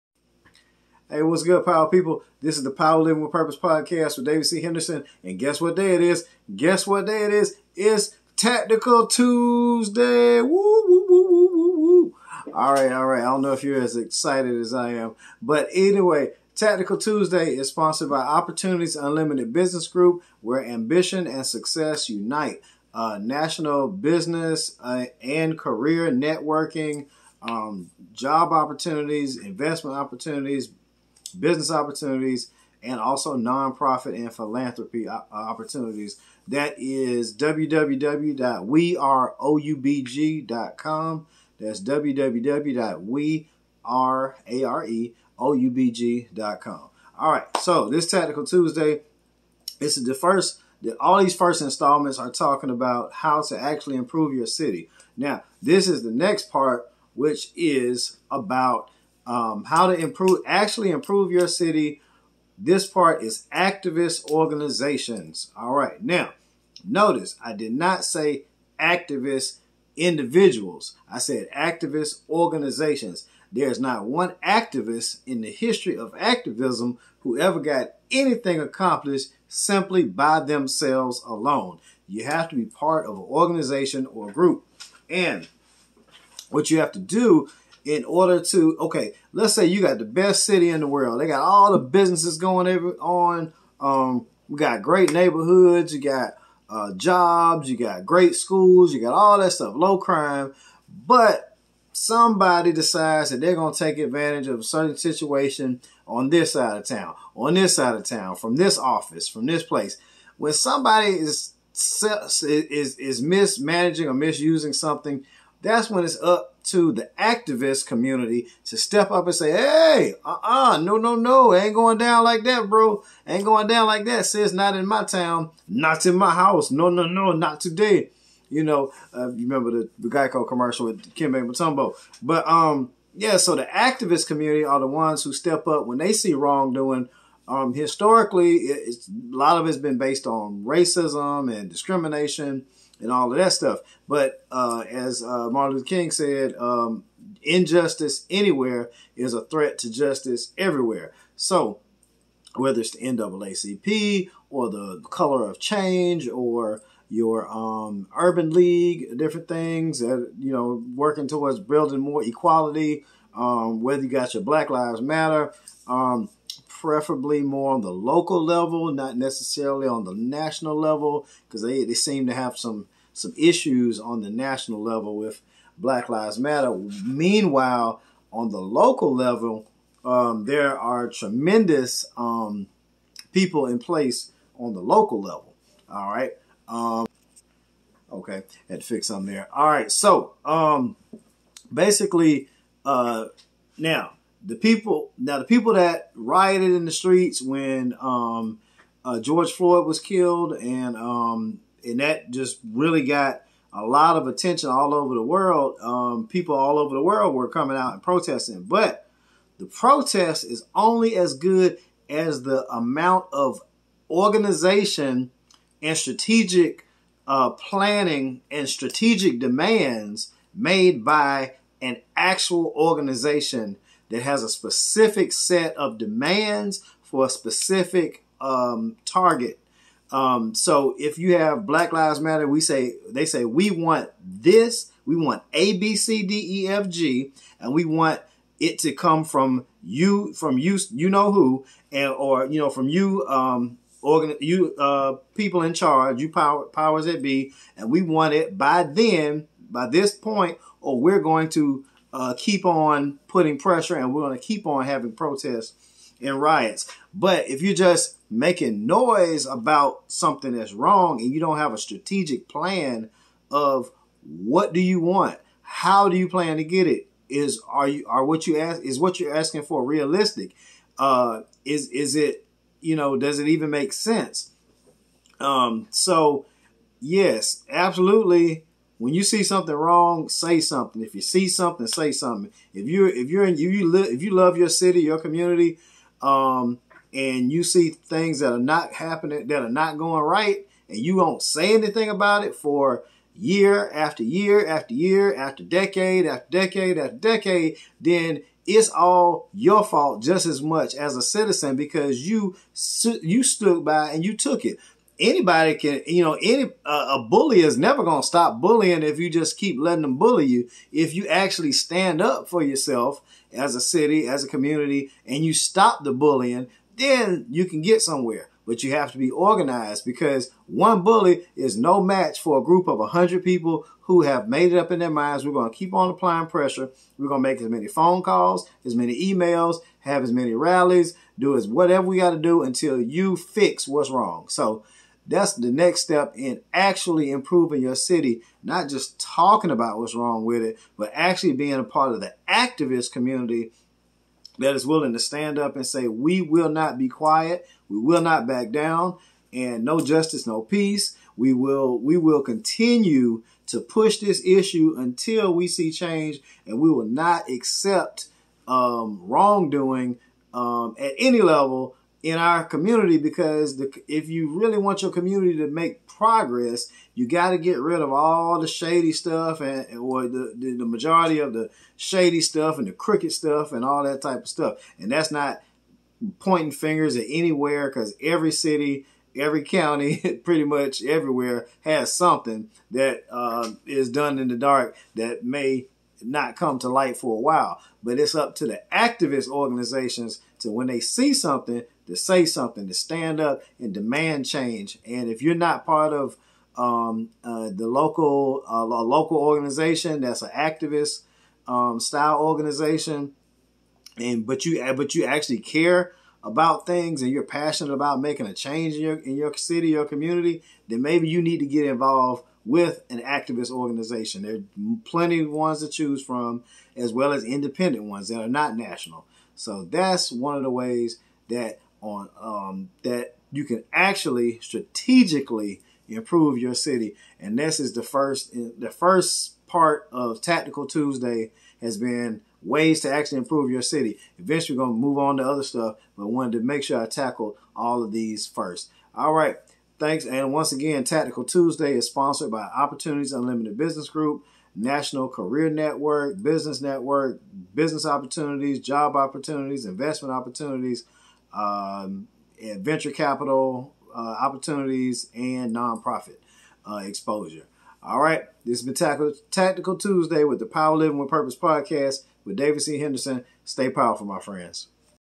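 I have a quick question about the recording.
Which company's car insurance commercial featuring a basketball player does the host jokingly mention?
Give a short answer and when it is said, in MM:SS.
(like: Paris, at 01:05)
Geico, at 02:10.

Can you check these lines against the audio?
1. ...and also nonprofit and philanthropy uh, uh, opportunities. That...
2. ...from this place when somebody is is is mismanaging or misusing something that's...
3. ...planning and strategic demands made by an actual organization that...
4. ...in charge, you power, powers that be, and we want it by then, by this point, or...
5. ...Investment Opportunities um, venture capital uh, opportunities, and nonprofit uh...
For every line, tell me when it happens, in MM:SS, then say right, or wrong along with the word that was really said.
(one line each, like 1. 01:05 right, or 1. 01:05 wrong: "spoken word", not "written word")
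1. 00:32 right
2. 01:49 right
3. 03:37 right
4. 04:05 right
5. 07:29 right.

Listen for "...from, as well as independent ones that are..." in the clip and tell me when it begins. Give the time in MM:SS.
06:56.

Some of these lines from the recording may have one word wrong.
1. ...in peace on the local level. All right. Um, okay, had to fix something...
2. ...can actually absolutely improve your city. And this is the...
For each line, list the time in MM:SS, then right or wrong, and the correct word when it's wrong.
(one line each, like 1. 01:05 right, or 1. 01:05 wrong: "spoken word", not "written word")
1. 03:03 wrong: "place", not "peace"
2. 07:03 wrong: "strategically", not "absolutely".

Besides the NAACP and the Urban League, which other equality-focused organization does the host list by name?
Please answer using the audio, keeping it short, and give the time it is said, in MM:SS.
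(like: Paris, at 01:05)
Color of Change, at 02:35.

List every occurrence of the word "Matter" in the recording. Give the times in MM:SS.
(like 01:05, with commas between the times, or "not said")
02:45, 02:56, 03:52.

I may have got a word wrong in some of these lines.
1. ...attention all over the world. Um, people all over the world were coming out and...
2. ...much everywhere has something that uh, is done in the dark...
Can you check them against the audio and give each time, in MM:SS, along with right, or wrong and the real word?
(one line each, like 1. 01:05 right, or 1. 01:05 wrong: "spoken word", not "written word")
1. 03:24 right
2. 06:20 right.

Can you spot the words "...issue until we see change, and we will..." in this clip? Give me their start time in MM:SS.
05:54.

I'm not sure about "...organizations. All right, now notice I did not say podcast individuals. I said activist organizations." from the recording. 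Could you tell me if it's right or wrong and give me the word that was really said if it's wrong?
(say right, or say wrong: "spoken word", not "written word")
wrong: "activist", not "podcast".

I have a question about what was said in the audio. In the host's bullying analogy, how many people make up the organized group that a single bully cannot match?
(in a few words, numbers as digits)
100.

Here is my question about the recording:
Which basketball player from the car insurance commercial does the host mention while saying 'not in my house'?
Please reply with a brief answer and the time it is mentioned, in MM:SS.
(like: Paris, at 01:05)
Dikembe Mutombo, at 02:11.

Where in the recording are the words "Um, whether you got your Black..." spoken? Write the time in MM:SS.
02:43.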